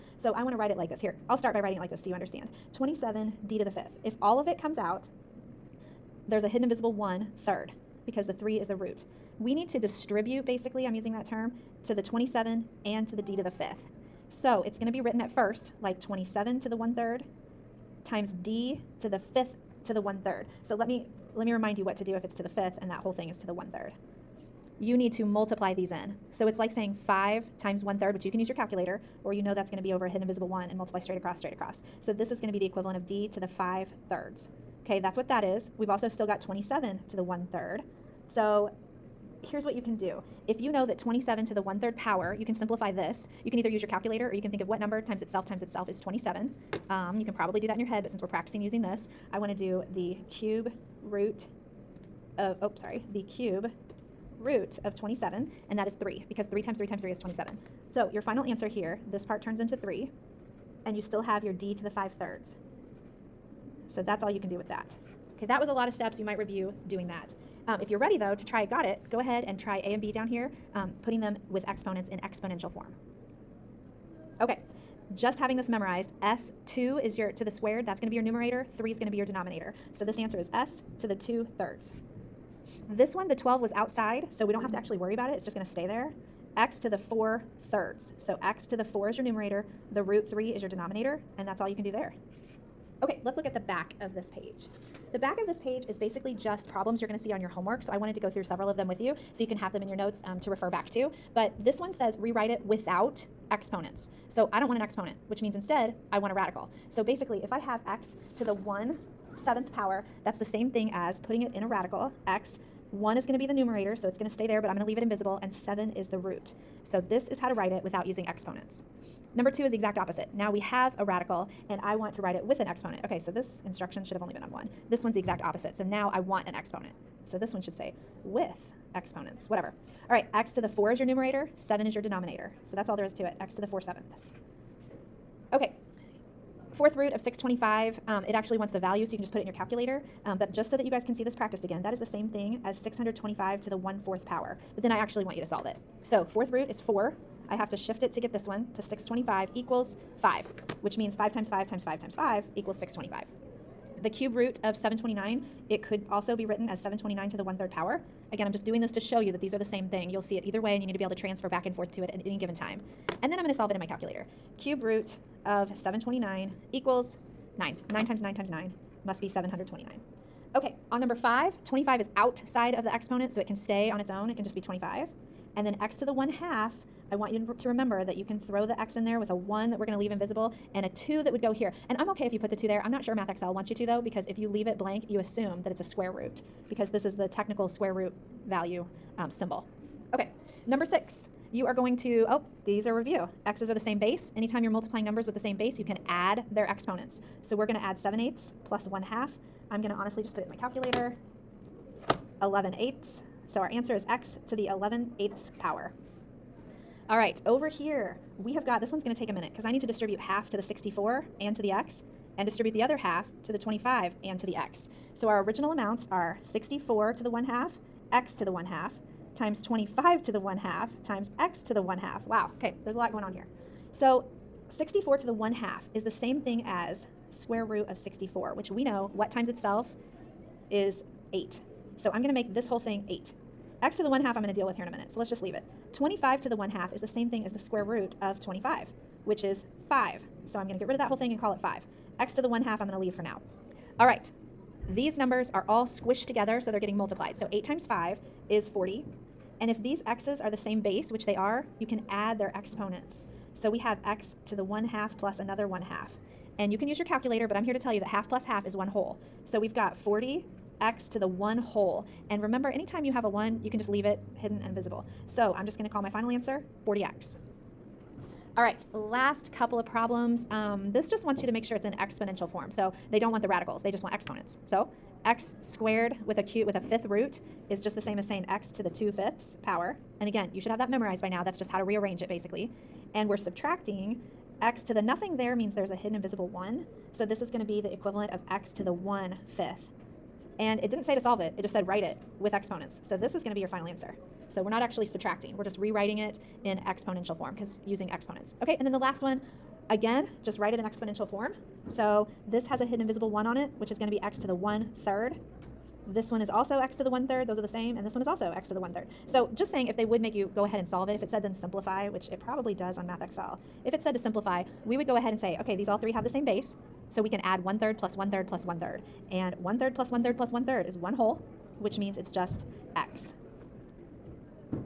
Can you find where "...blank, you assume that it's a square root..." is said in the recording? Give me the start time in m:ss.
3:04.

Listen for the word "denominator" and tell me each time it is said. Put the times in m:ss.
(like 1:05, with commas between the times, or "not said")
1:19, 1:30, 2:12.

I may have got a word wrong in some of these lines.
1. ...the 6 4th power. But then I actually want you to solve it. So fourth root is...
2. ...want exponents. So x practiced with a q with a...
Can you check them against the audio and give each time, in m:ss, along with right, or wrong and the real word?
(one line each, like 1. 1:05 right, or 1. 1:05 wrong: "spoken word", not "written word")
1. 2:23 wrong: "1", not "6"
2. 4:34 wrong: "squared", not "practiced".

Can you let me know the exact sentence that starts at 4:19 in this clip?
So we've got 40x to the 1 whole.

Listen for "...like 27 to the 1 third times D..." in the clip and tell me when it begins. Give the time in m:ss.
0:15.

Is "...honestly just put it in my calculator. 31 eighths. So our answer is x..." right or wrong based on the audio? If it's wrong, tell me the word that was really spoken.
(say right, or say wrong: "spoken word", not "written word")
wrong: "11", not "31".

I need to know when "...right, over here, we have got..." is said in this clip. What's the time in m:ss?
3:27.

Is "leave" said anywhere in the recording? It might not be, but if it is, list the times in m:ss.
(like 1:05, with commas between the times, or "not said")
1:54, 2:59, 3:04, 3:55, 4:02, 4:23.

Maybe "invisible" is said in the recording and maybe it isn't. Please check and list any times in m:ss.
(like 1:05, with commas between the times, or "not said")
0:06, 0:30, 1:55, 3:00, 4:24, 4:46, 5:03.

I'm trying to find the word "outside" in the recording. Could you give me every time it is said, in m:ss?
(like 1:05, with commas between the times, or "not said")
1:23, 2:52.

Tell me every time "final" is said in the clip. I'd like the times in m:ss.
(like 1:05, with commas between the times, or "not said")
0:58, 4:26, 4:53.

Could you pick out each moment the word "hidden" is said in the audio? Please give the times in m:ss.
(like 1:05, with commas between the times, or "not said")
0:06, 0:30, 4:24, 4:45, 5:02.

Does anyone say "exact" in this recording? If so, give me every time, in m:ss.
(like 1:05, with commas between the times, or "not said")
1:59, 2:05.